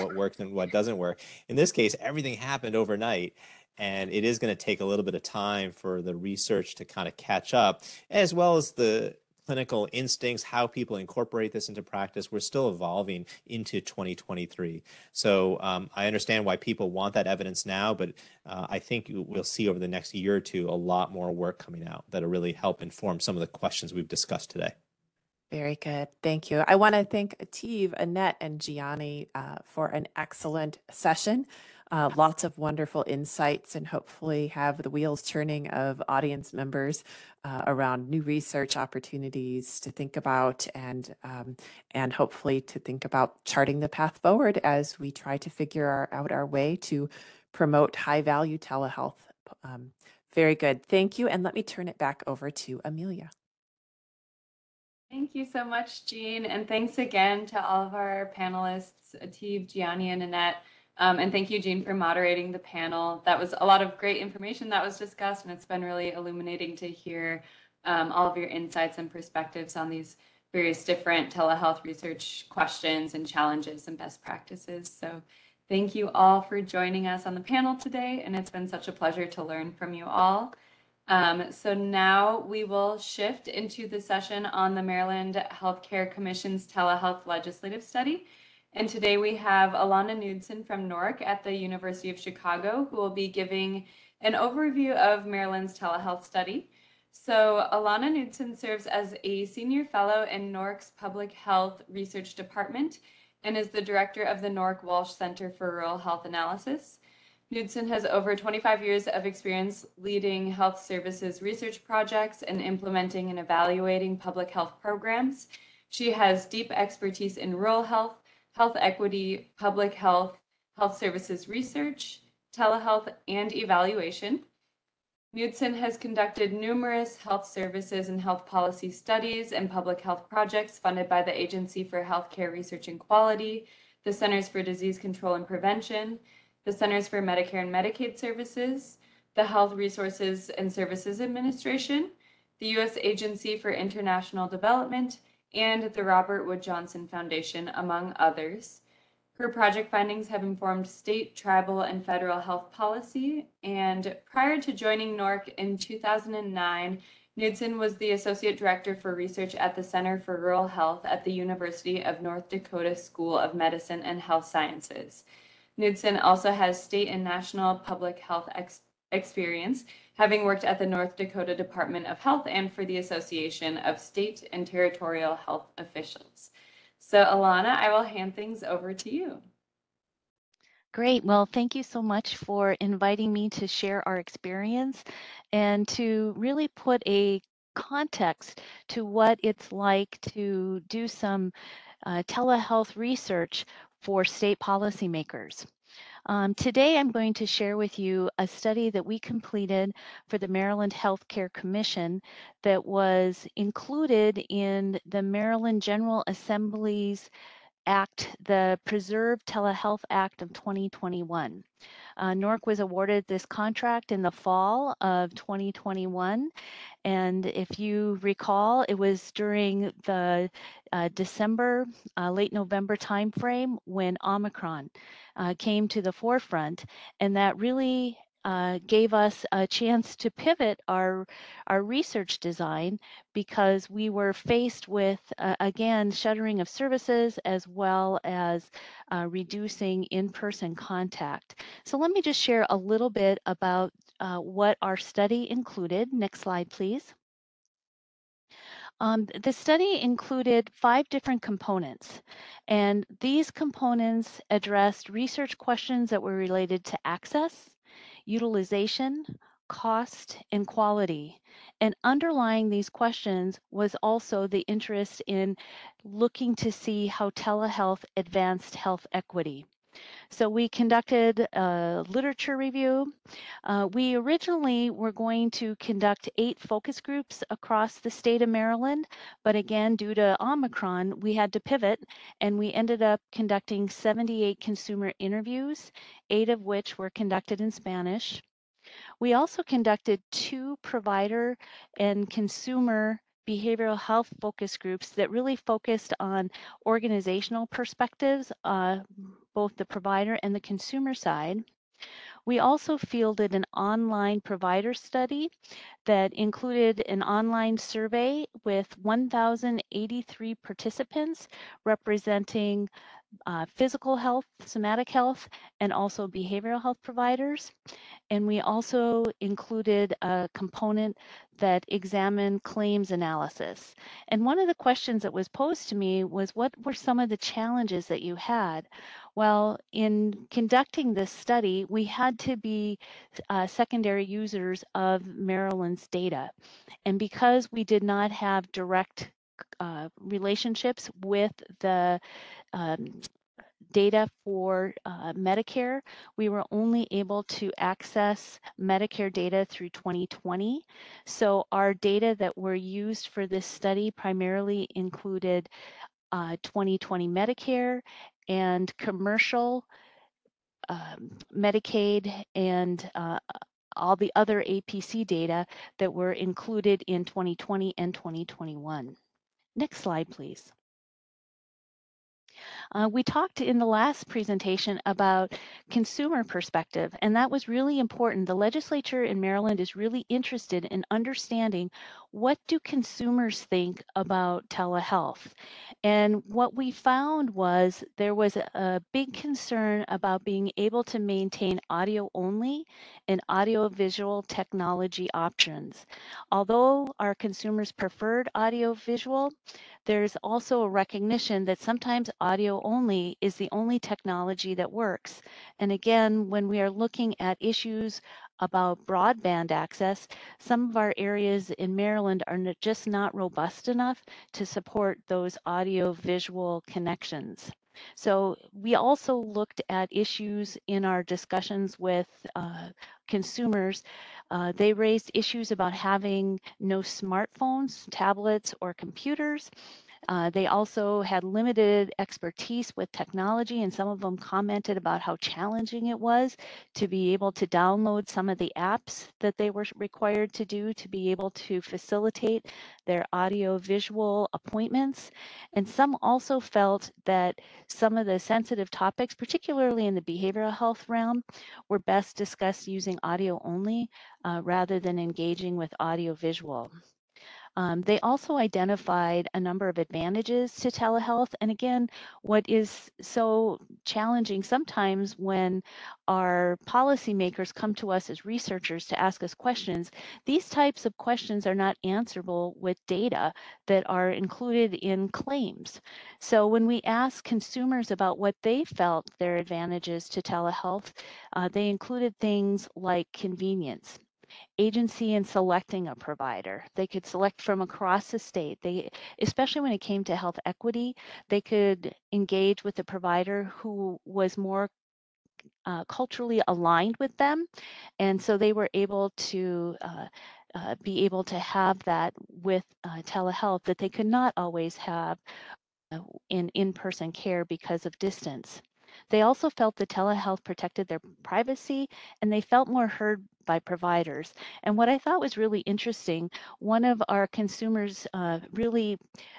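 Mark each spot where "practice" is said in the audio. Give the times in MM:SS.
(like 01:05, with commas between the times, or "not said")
00:11, 01:14.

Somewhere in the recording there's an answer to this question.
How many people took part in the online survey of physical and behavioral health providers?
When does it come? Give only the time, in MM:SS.
05:08.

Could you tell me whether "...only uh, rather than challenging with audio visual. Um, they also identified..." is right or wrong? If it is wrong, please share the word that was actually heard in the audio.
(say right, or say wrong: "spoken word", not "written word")
wrong: "engaging", not "challenging".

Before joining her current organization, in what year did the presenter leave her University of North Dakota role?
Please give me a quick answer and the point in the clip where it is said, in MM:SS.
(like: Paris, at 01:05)
2009, at 02:35.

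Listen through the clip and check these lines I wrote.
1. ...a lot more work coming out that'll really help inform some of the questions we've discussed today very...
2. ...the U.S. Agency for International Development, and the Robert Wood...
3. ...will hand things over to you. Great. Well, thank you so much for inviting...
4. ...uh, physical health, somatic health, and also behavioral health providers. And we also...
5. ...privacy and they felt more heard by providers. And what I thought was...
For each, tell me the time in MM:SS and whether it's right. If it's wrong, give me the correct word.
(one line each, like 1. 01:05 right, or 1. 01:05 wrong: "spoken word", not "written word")
1. 00:20 right
2. 02:22 right
3. 02:57 right
4. 05:13 right
5. 08:31 right.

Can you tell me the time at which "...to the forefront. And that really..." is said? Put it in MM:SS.
03:45.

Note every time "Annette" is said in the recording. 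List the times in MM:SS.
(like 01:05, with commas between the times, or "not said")
00:27, 01:00.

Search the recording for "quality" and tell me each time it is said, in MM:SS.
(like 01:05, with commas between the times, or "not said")
02:12, 04:20.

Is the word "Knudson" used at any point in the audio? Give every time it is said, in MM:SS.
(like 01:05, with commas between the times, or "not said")
01:30, 01:38, 01:47, 02:05, 02:37, 02:45.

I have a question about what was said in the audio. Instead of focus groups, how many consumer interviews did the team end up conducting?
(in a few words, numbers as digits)
78.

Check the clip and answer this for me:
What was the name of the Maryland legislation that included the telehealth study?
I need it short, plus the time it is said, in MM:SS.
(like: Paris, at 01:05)
Preserve Telehealth Act of 2021, at 03:28.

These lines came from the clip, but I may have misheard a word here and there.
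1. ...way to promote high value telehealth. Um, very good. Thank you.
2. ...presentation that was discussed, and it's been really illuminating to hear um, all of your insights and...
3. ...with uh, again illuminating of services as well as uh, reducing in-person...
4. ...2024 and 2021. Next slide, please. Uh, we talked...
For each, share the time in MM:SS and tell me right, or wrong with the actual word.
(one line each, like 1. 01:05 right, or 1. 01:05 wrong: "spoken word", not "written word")
1. 00:46 right
2. 01:04 wrong: "information", not "presentation"
3. 03:54 wrong: "shuttering", not "illuminating"
4. 06:07 wrong: "2020", not "2024".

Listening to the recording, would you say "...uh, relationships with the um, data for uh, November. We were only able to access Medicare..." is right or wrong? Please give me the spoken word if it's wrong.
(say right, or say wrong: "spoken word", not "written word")
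wrong: "Medicare", not "November".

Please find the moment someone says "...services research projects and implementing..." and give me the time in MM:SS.
01:50.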